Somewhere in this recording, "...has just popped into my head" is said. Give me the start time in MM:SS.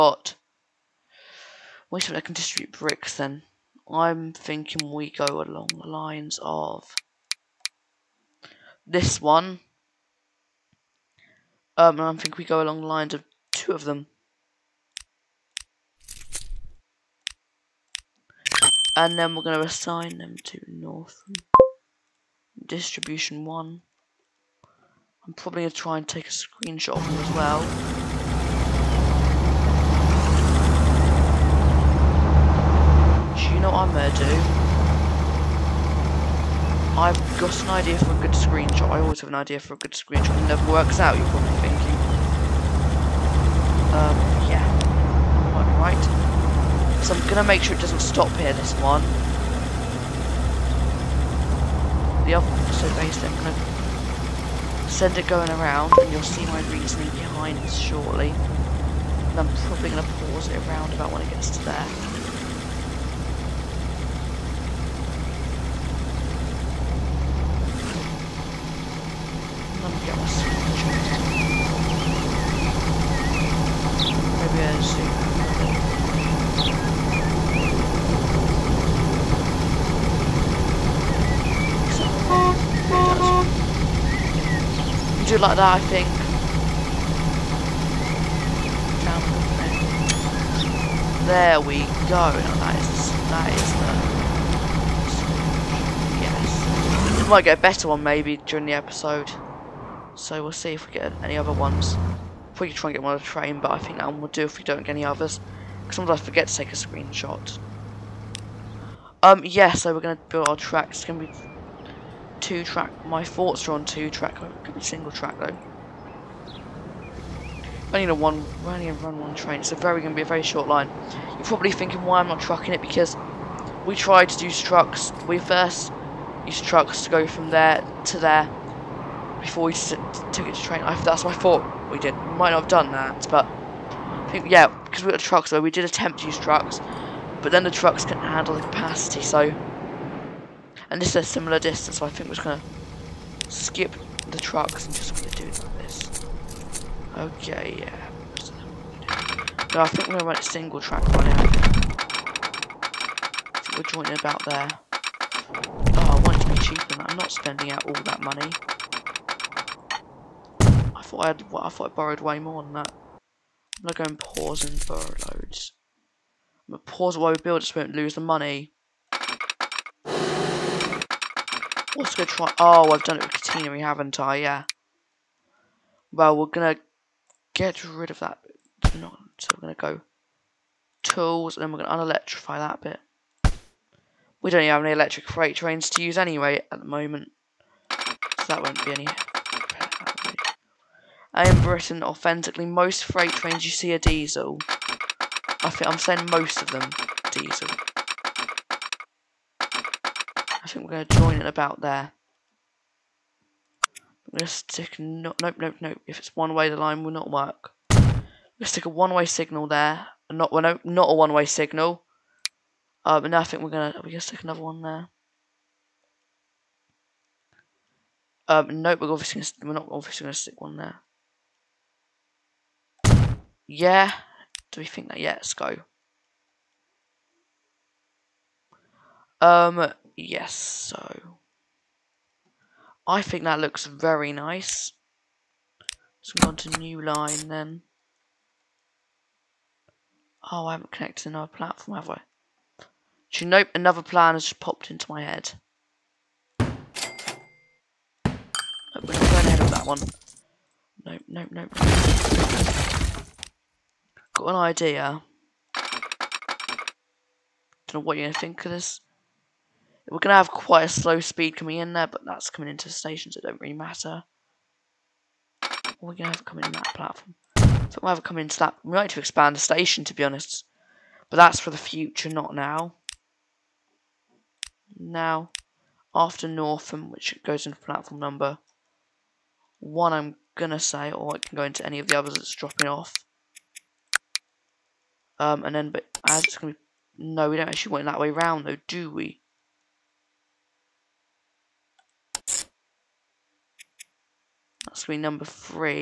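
04:04.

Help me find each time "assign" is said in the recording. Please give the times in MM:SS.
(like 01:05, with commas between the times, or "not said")
00:19.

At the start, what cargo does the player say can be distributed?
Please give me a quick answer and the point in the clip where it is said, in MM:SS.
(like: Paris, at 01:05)
Bricks, at 00:02.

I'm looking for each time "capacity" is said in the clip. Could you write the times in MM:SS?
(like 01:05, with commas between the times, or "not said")
02:18.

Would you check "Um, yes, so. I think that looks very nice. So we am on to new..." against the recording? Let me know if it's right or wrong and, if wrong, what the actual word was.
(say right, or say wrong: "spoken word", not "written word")
right.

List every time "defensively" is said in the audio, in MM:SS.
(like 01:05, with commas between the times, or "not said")
not said.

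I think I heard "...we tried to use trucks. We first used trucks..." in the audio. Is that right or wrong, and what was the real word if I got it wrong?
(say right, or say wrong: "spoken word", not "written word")
right.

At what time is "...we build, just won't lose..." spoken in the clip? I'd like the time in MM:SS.
02:47.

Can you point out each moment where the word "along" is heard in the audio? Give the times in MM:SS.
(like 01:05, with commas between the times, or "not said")
00:05, 00:12.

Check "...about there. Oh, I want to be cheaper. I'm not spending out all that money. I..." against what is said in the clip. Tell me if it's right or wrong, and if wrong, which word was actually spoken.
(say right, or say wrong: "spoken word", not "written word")
right.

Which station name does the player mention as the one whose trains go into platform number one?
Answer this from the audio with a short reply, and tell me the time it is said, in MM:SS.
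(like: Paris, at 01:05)
Northam, at 04:36.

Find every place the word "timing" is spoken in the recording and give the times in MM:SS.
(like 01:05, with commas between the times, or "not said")
not said.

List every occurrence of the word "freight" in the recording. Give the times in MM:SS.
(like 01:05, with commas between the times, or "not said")
03:05, 03:13.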